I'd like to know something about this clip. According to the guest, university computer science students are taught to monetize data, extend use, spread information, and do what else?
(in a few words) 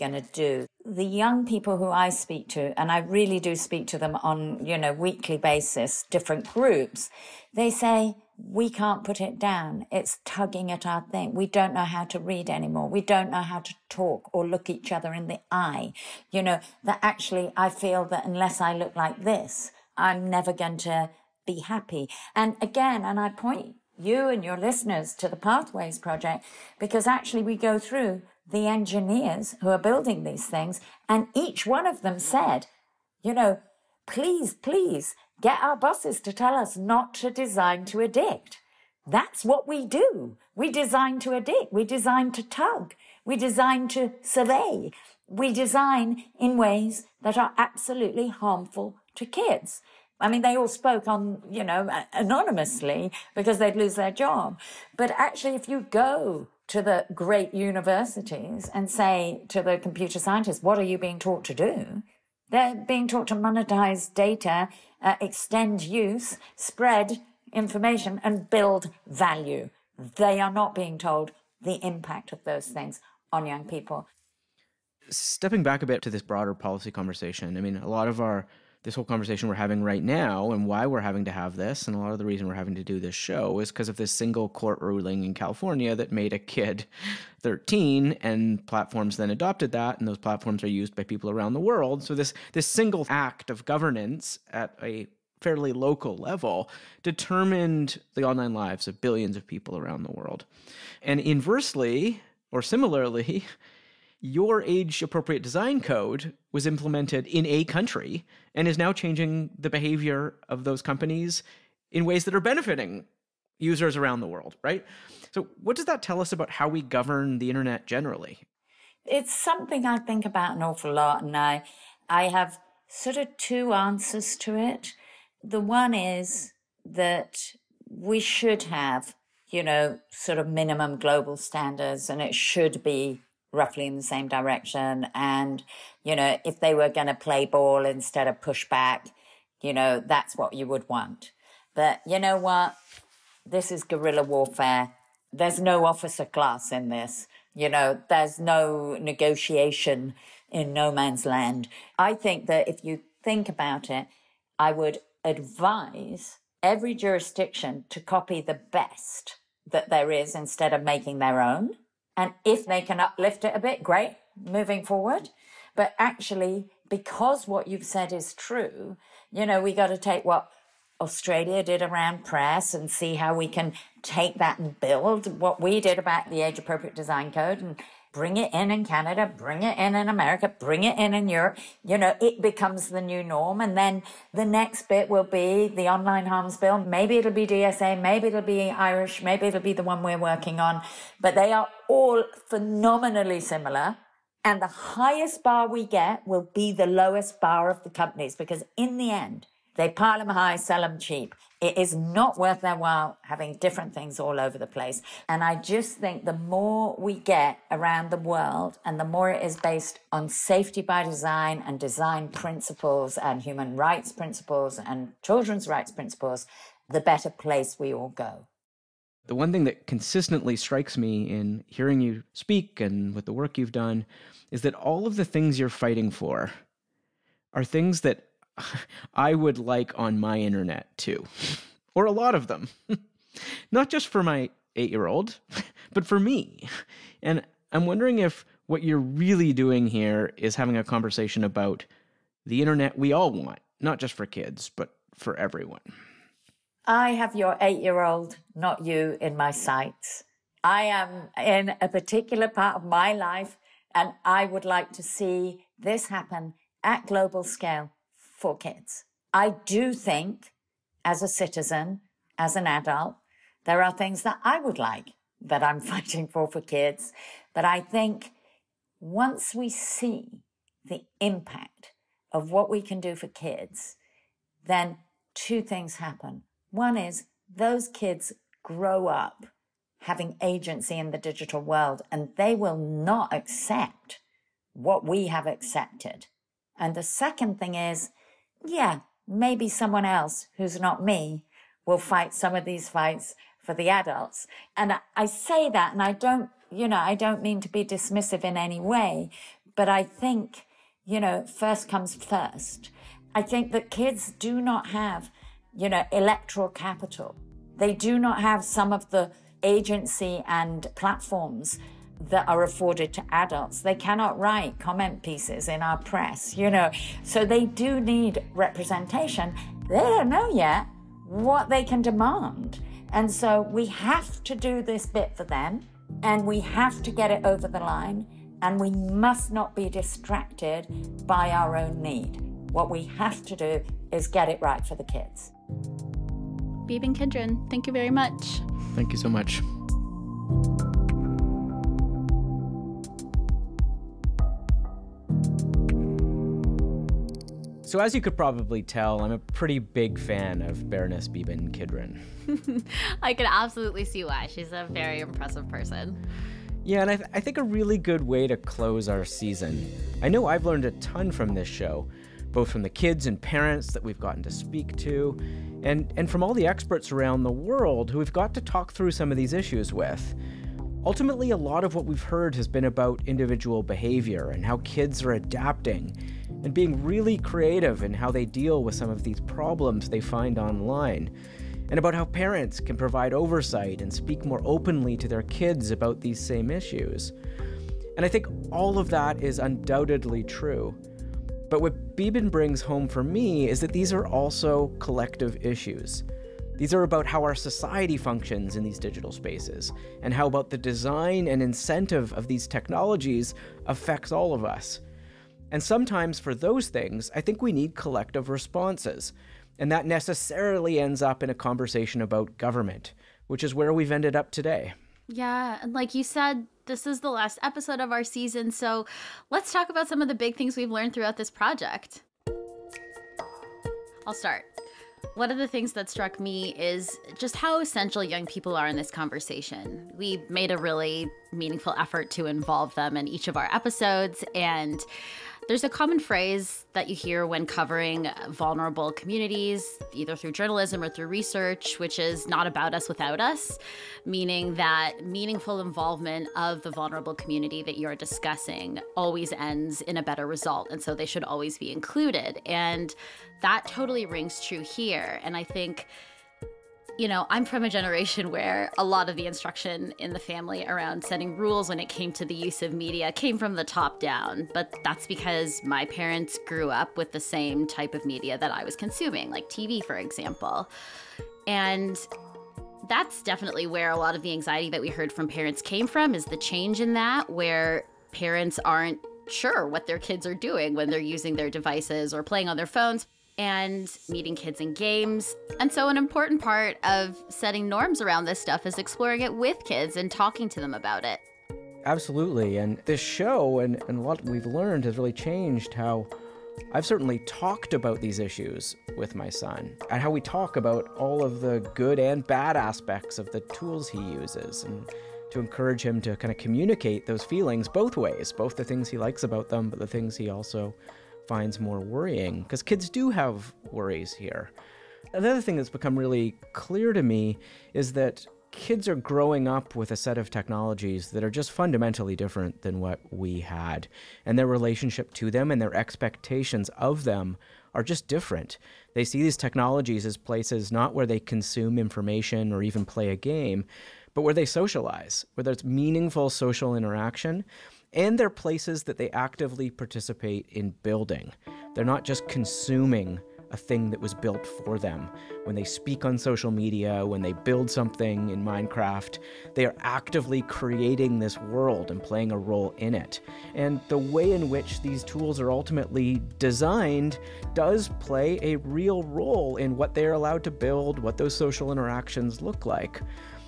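build value.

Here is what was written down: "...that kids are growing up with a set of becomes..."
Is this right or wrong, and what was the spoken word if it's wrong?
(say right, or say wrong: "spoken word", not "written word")
wrong: "technologies", not "becomes".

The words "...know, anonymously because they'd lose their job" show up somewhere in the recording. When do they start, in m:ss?
0:51.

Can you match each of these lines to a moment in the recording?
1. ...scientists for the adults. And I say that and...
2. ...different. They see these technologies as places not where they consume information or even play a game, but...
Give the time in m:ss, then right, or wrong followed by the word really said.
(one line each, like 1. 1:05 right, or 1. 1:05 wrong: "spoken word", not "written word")
1. 4:52 wrong: "fights", not "scientists"
2. 8:48 right.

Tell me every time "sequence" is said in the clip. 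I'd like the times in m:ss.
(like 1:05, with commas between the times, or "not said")
not said.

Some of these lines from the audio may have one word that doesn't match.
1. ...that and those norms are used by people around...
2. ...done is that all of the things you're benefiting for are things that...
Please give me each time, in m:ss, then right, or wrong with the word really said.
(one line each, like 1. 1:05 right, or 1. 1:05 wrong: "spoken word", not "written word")
1. 1:29 wrong: "platforms", not "norms"
2. 3:43 wrong: "fighting", not "benefiting".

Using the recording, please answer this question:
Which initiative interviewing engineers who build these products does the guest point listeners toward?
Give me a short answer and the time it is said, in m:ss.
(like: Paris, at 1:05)
Pathways Project, at 0:25.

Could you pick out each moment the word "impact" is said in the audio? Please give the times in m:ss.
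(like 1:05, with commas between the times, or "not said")
1:11, 4:31.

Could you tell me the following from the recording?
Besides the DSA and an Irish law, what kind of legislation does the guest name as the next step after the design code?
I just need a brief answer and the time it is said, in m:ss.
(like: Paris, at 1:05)
online harms bill, at 3:05.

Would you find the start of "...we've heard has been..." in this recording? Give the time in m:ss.
6:12.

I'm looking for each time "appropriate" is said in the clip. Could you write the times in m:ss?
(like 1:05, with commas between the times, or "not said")
1:45, 2:56.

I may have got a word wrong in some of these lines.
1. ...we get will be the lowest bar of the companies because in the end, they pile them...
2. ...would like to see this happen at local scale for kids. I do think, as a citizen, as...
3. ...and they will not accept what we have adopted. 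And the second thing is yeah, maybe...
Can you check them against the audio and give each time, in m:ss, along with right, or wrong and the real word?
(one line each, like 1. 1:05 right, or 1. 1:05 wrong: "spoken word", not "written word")
1. 3:15 right
2. 4:14 wrong: "global", not "local"
3. 4:42 wrong: "accepted", not "adopted".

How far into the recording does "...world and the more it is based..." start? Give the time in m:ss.
3:28.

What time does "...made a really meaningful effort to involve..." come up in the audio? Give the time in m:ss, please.
7:10.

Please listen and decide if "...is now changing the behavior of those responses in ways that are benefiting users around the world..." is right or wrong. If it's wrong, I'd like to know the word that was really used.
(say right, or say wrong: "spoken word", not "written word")
wrong: "companies", not "responses".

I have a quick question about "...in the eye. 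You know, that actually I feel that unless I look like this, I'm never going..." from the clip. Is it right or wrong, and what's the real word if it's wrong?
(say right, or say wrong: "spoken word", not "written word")
right.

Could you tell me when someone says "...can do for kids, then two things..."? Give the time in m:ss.
4:32.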